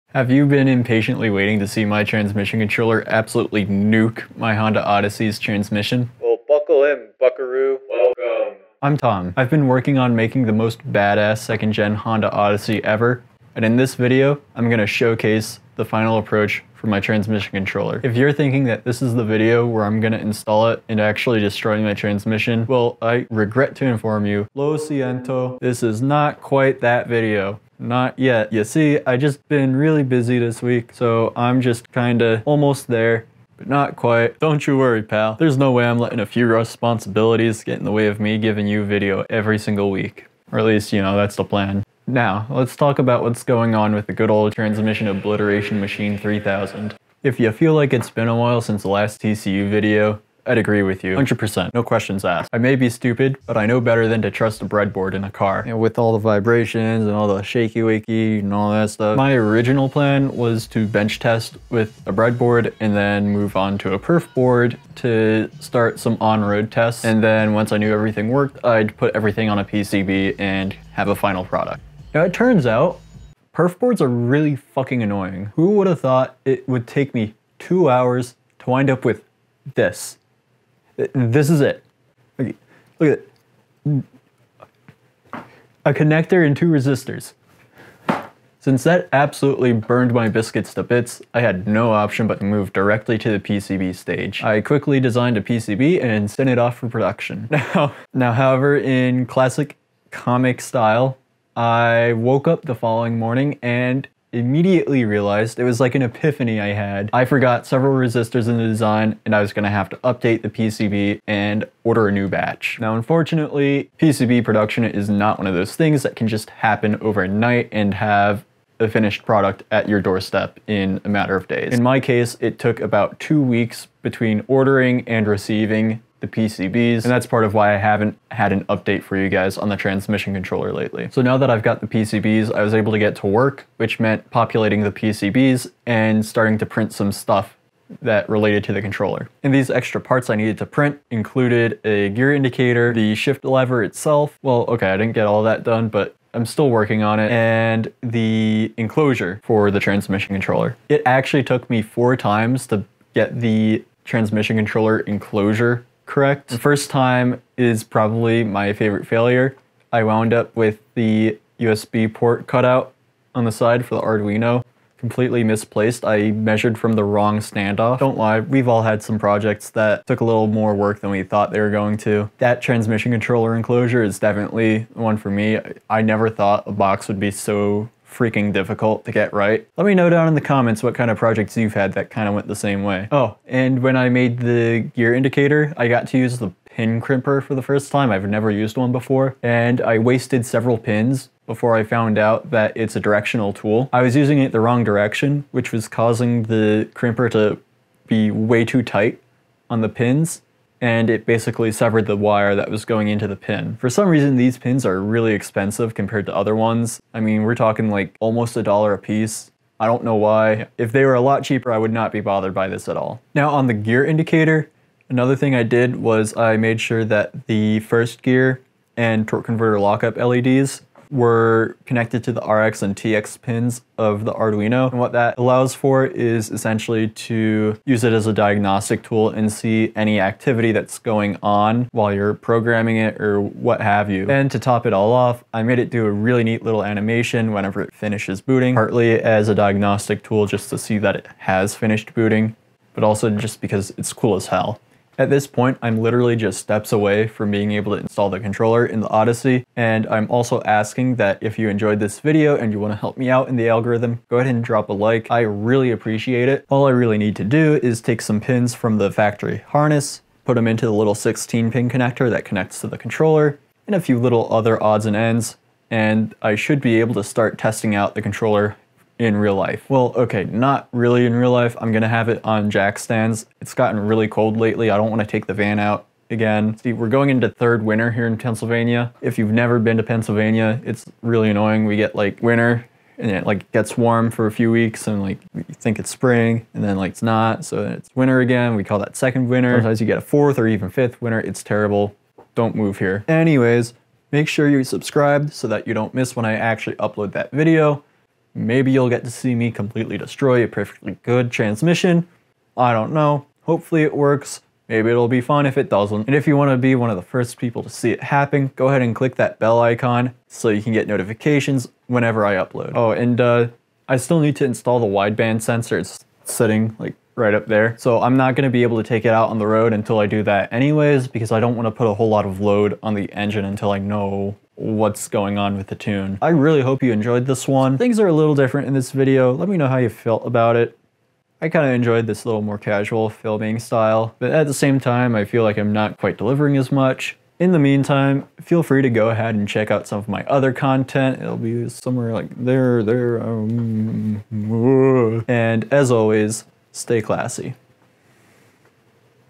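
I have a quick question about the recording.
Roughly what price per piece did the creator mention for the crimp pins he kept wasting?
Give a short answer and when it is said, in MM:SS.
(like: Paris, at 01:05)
almost a dollar, at 03:28.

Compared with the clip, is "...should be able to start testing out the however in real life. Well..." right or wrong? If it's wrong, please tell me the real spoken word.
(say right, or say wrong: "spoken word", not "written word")
wrong: "controller", not "however".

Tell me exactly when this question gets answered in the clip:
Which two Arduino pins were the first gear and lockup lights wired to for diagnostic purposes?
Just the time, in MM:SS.
03:42.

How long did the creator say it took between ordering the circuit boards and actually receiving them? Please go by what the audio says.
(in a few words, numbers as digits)
2 weeks.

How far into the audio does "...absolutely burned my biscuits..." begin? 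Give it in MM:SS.
01:29.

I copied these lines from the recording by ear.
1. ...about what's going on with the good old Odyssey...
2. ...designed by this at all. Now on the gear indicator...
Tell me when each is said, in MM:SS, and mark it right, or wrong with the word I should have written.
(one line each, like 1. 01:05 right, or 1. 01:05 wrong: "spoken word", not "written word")
1. 00:42 wrong: "Transmission", not "Odyssey"
2. 03:32 wrong: "bothered", not "designed".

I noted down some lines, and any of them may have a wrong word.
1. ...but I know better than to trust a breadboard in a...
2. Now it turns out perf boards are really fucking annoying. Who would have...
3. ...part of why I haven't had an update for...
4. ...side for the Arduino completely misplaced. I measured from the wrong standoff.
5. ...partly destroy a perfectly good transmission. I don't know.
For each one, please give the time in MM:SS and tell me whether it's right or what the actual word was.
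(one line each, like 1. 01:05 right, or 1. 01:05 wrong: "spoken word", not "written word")
1. 00:53 right
2. 01:12 right
3. 02:07 right
4. 02:43 right
5. 04:59 wrong: "completely", not "partly".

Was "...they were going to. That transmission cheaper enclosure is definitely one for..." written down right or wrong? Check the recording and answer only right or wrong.
wrong.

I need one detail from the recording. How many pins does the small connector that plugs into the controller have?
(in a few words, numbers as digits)
16.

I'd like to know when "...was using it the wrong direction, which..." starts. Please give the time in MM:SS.
03:14.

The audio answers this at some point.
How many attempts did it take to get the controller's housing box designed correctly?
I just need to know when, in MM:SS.
02:31.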